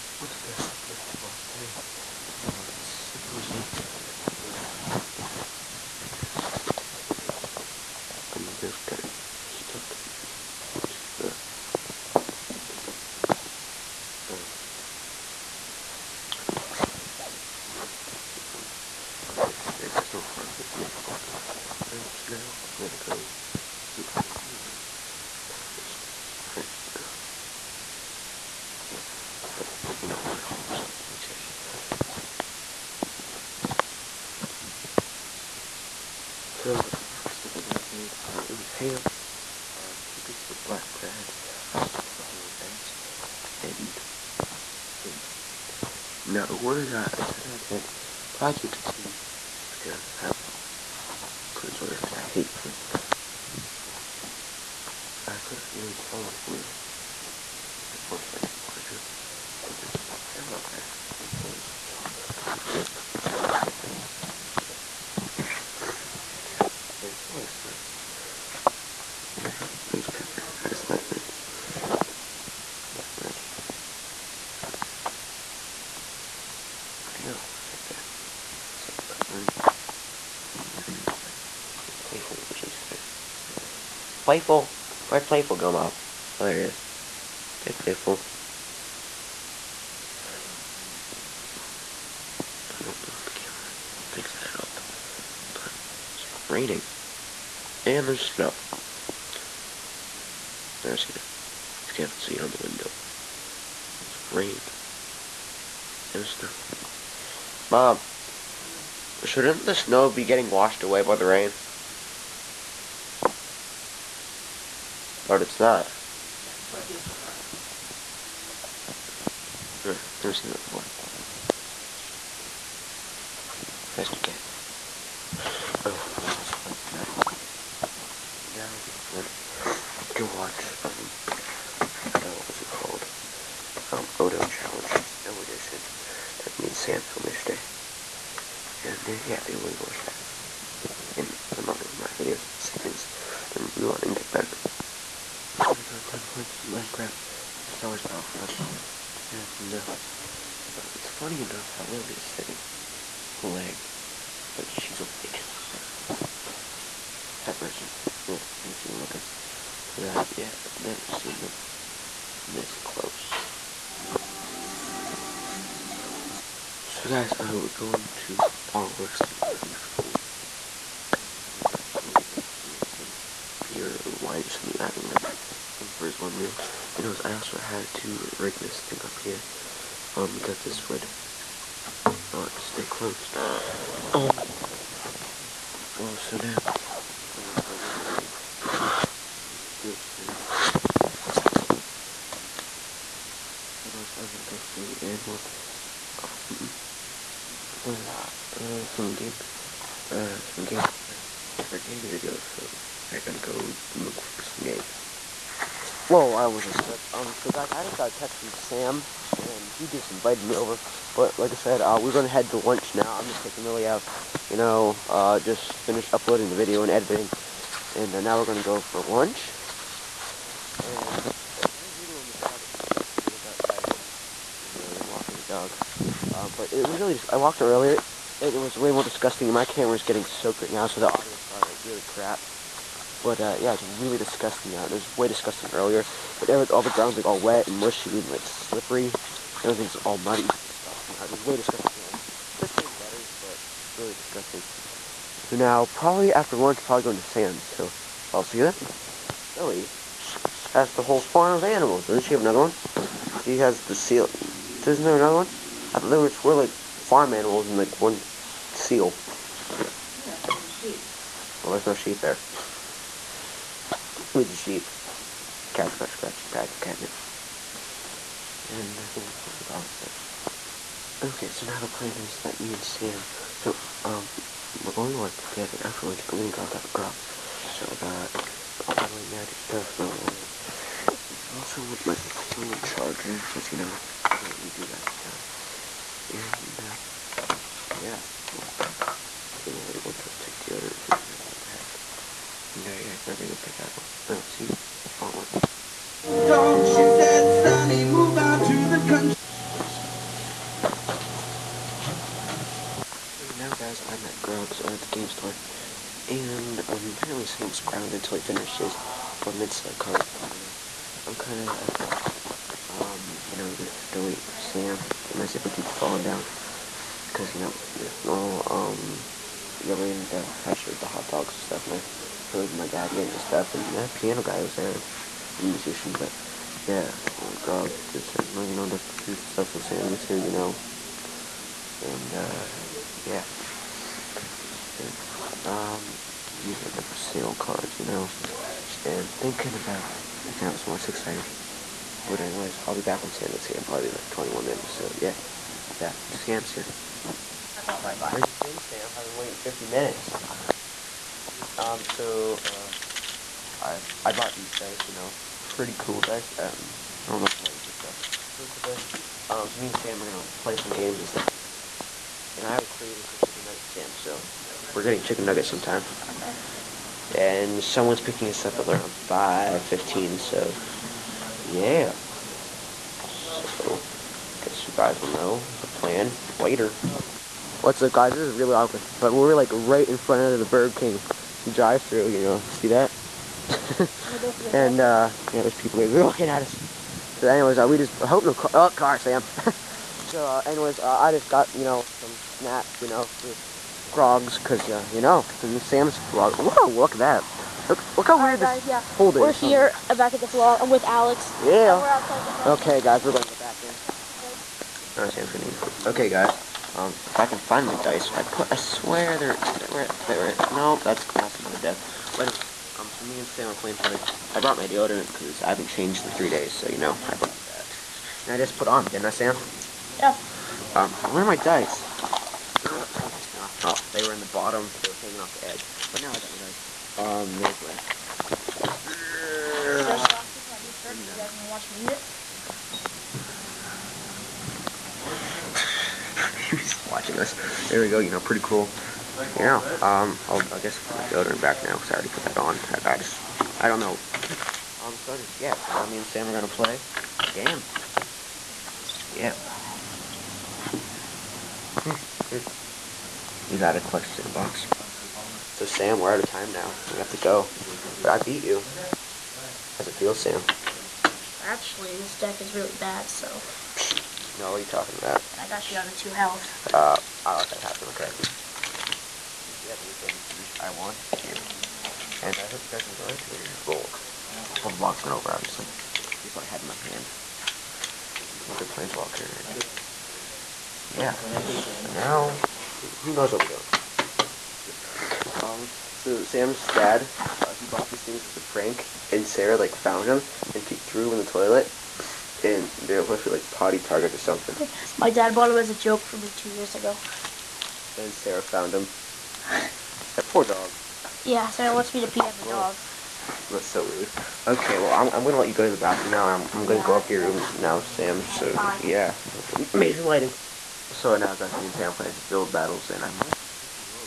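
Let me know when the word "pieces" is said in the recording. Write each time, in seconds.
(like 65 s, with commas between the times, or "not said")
40 s, 430 s.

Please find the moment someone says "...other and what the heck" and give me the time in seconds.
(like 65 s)
290 s.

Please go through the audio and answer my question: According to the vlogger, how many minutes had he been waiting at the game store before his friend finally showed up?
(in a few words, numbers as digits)
50.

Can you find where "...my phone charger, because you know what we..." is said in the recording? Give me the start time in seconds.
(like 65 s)
282 s.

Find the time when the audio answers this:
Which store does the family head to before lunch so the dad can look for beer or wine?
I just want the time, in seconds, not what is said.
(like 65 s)
168 s.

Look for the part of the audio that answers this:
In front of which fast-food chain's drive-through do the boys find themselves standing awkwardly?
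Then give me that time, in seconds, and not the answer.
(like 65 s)
380 s.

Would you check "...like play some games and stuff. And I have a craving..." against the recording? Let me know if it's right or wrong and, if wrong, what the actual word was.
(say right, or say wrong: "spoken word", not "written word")
right.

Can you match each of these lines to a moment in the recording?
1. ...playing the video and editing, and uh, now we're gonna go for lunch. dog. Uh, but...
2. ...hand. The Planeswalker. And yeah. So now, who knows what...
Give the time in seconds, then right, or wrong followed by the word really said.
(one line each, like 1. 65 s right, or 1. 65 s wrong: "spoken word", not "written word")
1. 216 s wrong: "uploading", not "playing"
2. 477 s right.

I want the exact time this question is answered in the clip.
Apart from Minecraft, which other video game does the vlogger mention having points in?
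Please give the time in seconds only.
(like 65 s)
147 s.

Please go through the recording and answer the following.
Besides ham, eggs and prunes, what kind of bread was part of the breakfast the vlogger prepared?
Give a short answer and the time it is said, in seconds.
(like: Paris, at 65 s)
black bread, at 40 s.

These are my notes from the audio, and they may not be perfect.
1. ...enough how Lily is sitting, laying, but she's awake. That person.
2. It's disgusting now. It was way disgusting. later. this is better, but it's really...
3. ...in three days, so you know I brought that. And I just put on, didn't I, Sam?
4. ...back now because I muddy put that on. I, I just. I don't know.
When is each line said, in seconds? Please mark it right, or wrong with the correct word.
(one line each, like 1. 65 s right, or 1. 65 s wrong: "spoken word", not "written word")
1. 151 s right
2. 240 s wrong: "earlier", not "later"
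3. 416 s right
4. 441 s wrong: "already", not "muddy".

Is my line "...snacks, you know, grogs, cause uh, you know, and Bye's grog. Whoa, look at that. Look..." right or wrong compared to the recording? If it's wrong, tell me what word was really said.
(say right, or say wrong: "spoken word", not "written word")
wrong: "Sam", not "Bye".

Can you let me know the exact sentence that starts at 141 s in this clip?
And some other of my videos, see things to improve on and get better.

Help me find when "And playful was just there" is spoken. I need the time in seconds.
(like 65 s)
80 s.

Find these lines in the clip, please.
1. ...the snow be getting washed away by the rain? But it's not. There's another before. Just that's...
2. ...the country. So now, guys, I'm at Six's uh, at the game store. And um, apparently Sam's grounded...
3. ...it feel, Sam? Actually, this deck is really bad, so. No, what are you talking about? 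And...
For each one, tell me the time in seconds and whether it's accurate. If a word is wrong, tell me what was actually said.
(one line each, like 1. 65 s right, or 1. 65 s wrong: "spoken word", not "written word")
1. 109 s right
2. 298 s wrong: "Grog", not "Six"
3. 460 s right.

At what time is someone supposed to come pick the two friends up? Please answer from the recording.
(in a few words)
5:15.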